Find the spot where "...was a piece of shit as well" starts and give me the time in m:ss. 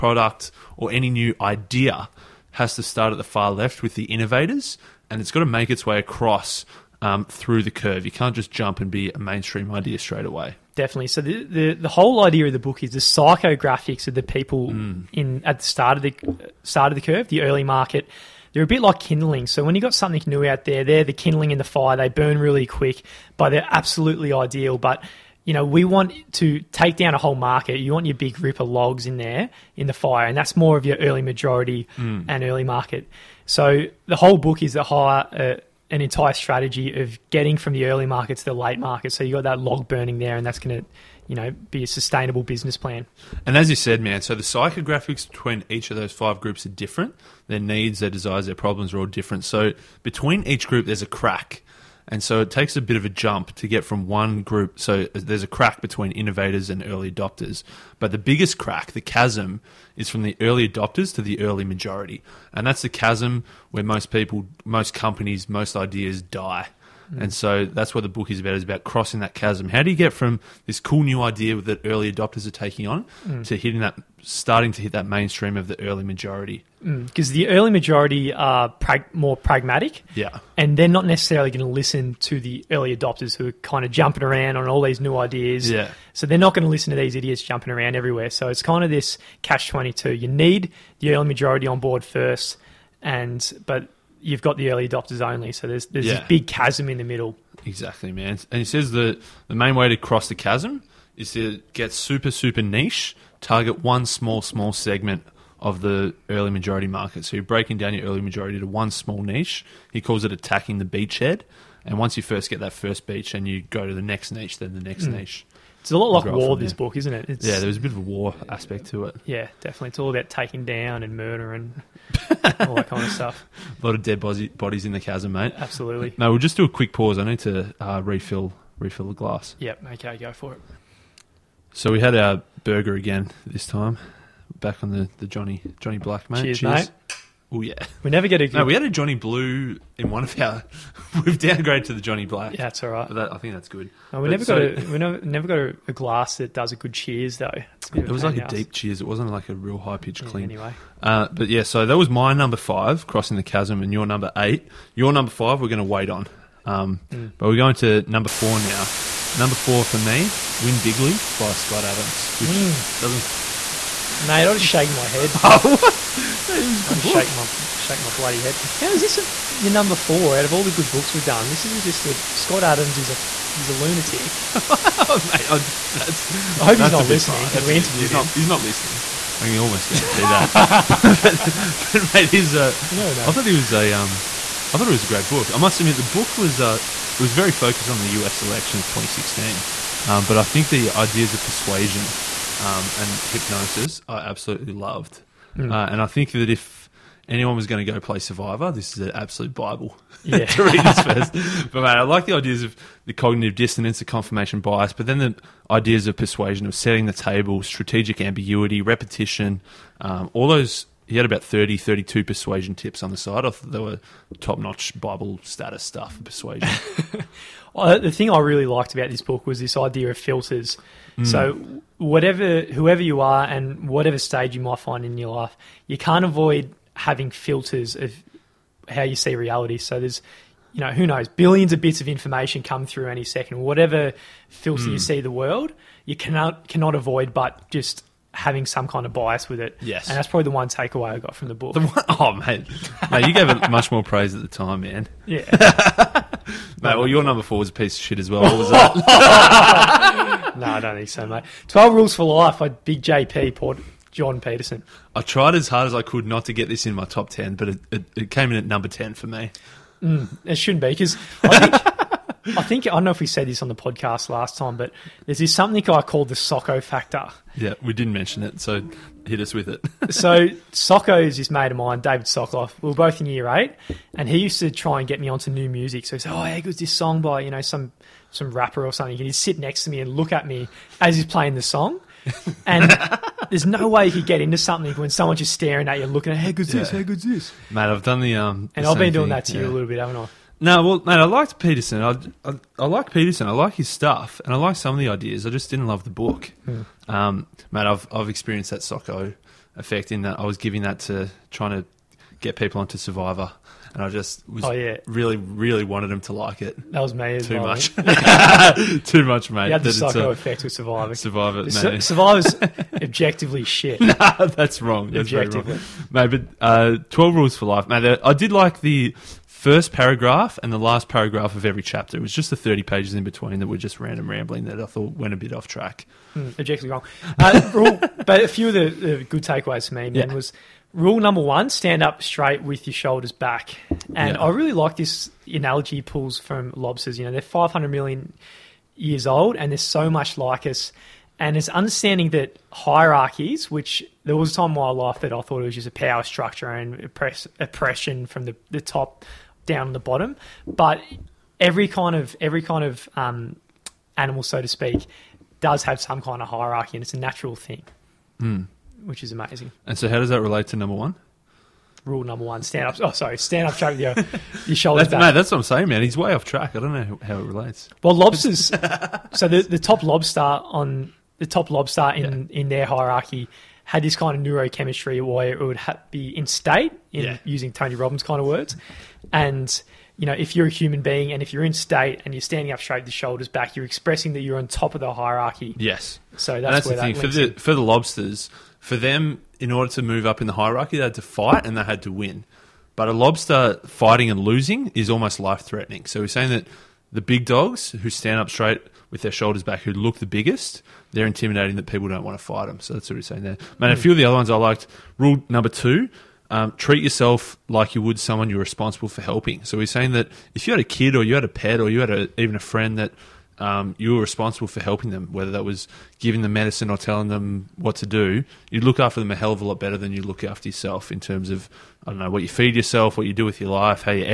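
4:07.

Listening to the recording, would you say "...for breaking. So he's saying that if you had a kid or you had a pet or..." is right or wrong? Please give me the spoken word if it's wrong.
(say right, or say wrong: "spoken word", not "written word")
wrong: "helping", not "breaking".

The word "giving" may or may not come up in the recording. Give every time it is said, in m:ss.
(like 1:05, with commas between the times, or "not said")
5:00, 6:56.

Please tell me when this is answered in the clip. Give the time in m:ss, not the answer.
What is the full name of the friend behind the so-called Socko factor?
4:32.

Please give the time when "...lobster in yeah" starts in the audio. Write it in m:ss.
6:11.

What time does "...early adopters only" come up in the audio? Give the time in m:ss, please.
1:34.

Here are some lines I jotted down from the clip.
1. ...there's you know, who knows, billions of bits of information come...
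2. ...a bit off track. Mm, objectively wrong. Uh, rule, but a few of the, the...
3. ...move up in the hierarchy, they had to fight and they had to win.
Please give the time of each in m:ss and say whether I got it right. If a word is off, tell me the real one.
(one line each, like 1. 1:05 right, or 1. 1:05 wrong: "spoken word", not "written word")
1. 3:49 right
2. 5:25 right
3. 6:30 right.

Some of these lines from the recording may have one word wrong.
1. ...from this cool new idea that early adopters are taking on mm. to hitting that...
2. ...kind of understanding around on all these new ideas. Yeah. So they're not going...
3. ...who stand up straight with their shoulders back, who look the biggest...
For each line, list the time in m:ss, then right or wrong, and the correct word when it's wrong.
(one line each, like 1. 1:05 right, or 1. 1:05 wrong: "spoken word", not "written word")
1. 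1:10 right
2. 1:23 wrong: "jumping", not "understanding"
3. 6:37 right.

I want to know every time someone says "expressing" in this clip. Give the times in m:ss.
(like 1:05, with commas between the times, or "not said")
6:23.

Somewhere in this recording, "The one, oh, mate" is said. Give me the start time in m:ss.
4:01.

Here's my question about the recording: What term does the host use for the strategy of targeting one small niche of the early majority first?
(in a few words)
Attacking the beachhead.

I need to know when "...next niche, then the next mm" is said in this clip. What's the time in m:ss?
1:54.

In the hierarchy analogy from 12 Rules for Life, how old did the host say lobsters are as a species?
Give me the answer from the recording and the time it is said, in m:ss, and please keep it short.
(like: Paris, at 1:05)
500 million years, at 5:37.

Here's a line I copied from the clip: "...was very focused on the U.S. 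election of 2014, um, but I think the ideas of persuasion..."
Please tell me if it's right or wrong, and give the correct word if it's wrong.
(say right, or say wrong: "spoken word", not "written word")
wrong: "2016", not "2014".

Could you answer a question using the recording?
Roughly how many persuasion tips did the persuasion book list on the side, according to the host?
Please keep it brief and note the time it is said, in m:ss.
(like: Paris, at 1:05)
32, at 3:31.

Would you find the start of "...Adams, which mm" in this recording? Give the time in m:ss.
2:41.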